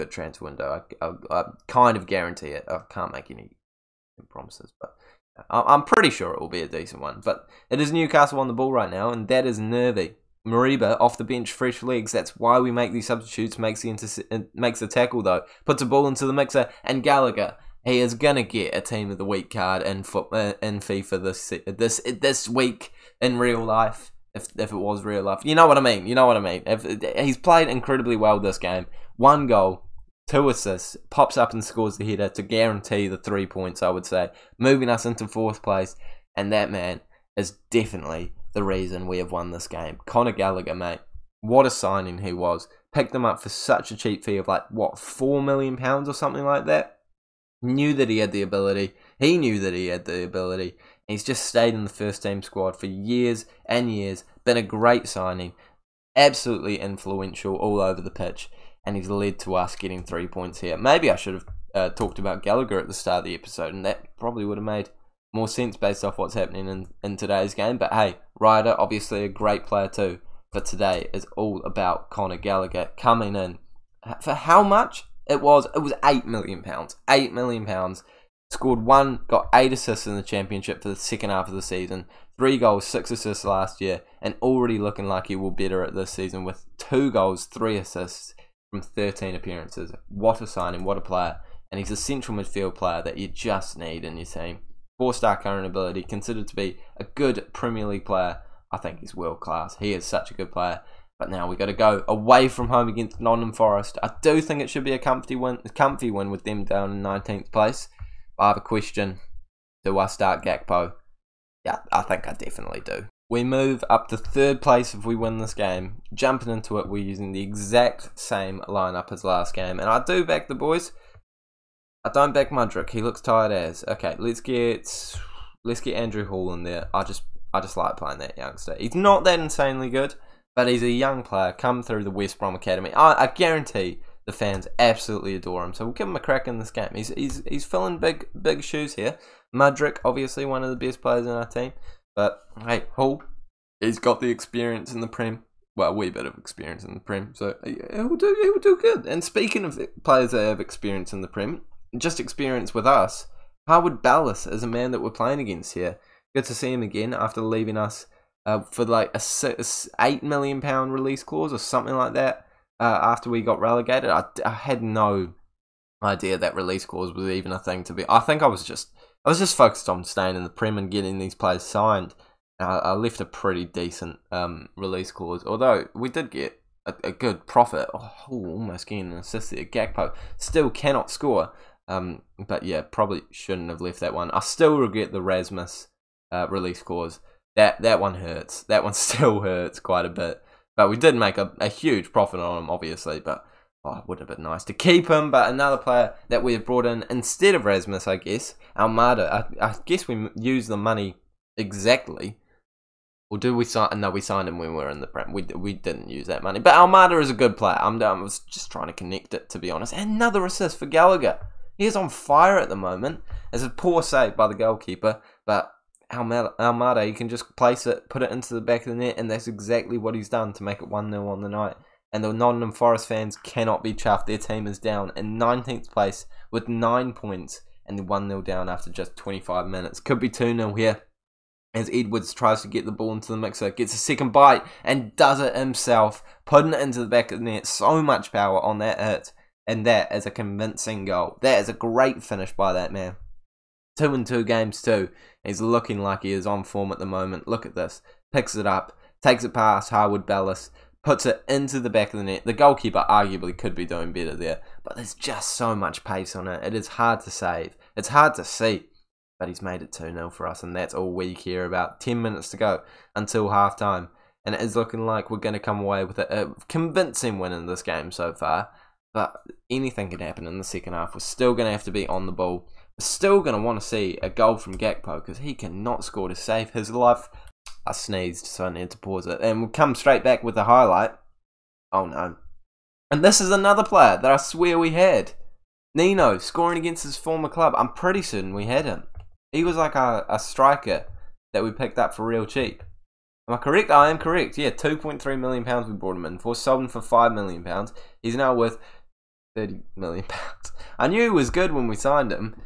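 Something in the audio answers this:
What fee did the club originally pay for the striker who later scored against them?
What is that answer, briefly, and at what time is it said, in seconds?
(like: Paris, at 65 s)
£2.3 million, at 294 s.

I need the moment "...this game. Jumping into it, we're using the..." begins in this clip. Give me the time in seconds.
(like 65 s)
115 s.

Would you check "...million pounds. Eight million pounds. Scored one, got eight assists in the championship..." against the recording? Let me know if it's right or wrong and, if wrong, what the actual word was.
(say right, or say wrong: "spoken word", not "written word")
right.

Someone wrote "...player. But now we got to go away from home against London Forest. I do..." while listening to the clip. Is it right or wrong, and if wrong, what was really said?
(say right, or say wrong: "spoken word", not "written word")
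right.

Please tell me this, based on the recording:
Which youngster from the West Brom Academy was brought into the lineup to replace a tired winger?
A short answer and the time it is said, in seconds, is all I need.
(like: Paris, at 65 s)
Andrew Hall, at 125 s.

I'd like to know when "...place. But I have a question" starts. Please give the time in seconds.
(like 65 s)
107 s.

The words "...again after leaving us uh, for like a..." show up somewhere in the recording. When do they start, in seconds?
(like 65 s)
156 s.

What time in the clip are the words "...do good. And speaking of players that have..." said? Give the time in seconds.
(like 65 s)
148 s.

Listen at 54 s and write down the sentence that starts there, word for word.
Been a great signing, absolutely influential all over the pitch, and he's led to us getting three points here.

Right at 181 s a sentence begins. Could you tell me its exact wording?
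Um, but yeah, probably shouldn't have left that one.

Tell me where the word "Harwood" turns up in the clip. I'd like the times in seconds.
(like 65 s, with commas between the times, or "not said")
153 s, 249 s.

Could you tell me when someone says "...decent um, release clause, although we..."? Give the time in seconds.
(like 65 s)
173 s.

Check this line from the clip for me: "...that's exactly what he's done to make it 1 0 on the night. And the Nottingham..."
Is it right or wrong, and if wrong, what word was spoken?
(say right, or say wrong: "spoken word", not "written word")
right.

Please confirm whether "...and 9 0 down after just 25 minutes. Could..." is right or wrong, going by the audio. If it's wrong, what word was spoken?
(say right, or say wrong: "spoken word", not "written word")
wrong: "1", not "9".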